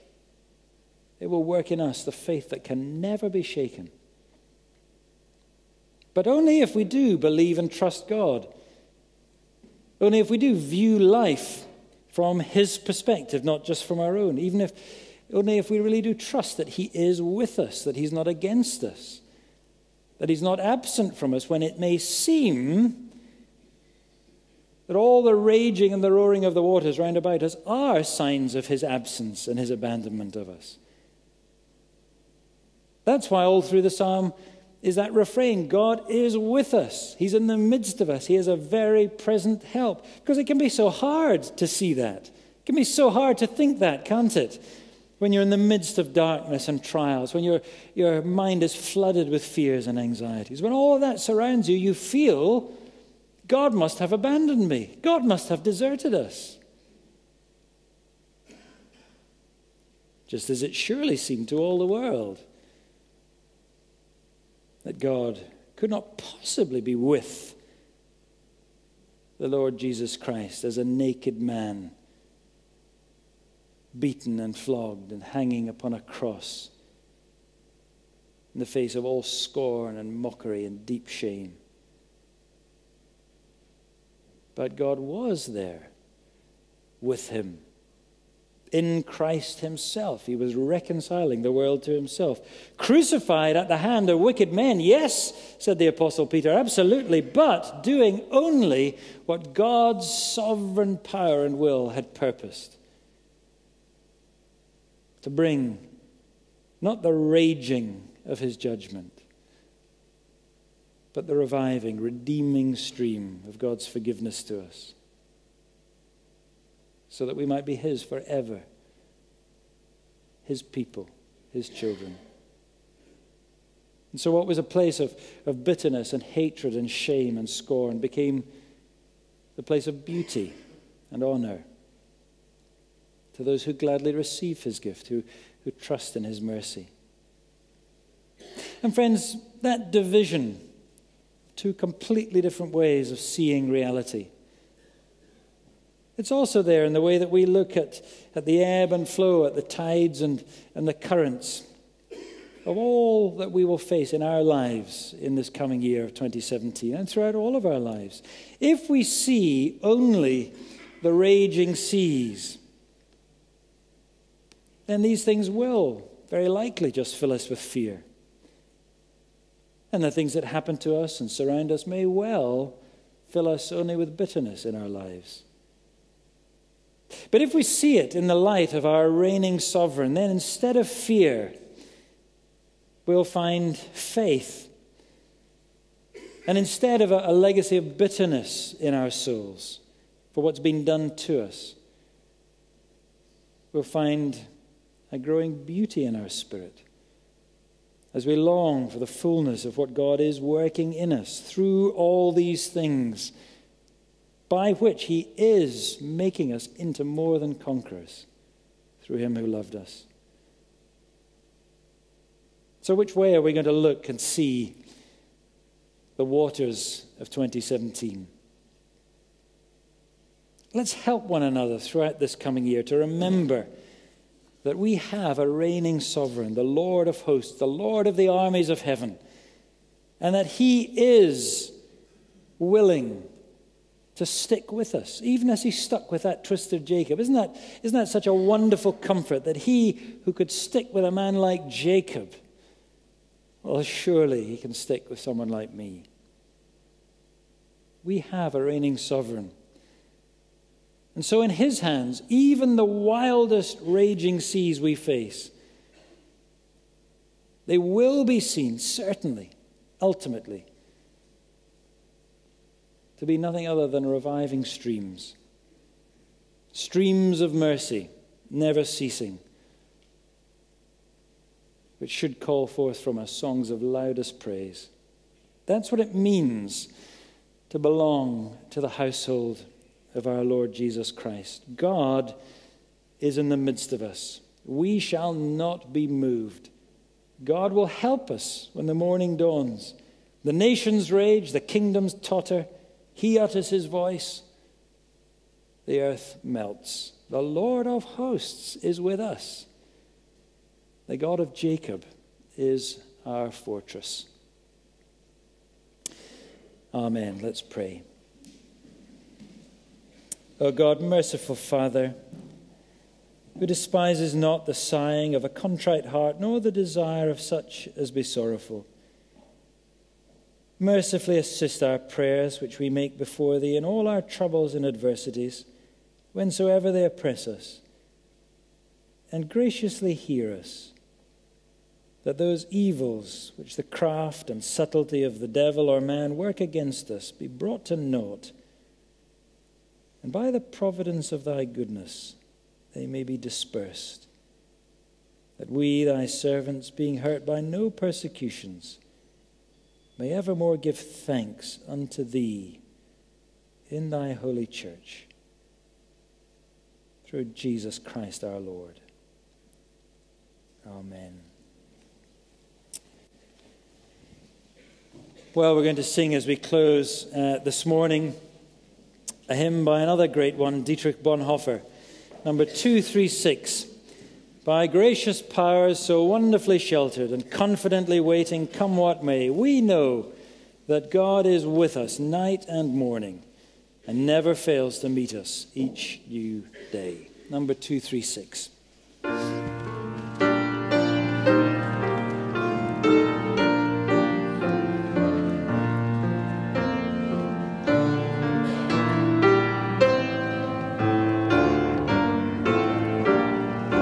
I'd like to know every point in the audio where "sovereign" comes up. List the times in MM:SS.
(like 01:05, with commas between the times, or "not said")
01:40, 02:59, 03:46, 04:08.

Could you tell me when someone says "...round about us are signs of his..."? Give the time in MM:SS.
00:26.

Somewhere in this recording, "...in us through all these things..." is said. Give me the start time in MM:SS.
03:20.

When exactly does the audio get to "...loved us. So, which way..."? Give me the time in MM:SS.
03:29.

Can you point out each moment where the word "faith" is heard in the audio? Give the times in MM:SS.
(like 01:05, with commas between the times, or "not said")
00:02, 03:03.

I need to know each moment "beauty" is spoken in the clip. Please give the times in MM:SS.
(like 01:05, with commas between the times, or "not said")
02:10, 03:15.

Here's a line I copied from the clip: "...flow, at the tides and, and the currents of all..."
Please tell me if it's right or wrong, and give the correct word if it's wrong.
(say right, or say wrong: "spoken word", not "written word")
right.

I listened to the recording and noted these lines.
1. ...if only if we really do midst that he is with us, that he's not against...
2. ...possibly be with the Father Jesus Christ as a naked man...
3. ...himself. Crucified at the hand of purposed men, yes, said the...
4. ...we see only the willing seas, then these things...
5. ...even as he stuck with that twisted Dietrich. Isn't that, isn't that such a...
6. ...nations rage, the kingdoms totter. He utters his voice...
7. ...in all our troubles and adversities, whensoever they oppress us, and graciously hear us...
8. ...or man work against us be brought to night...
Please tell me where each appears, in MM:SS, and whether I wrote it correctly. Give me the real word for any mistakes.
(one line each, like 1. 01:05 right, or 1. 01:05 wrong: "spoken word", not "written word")
1. 00:14 wrong: "trust", not "midst"
2. 01:06 wrong: "Lord", not "Father"
3. 01:31 wrong: "wicked", not "purposed"
4. 02:38 wrong: "raging", not "willing"
5. 03:55 wrong: "Jacob", not "Dietrich"
6. 04:50 right
7. 05:23 right
8. 05:35 wrong: "naught", not "night".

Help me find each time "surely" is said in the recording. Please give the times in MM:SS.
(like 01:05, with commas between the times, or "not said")
01:00, 04:03.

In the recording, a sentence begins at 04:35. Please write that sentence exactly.
That's what it means to belong to the household of our Lord Jesus Christ.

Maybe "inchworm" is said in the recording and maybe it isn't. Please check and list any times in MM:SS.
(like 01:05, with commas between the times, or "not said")
not said.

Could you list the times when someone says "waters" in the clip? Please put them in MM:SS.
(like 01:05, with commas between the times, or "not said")
00:26, 03:36.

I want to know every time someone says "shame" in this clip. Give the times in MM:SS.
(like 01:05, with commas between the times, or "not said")
01:21, 02:06.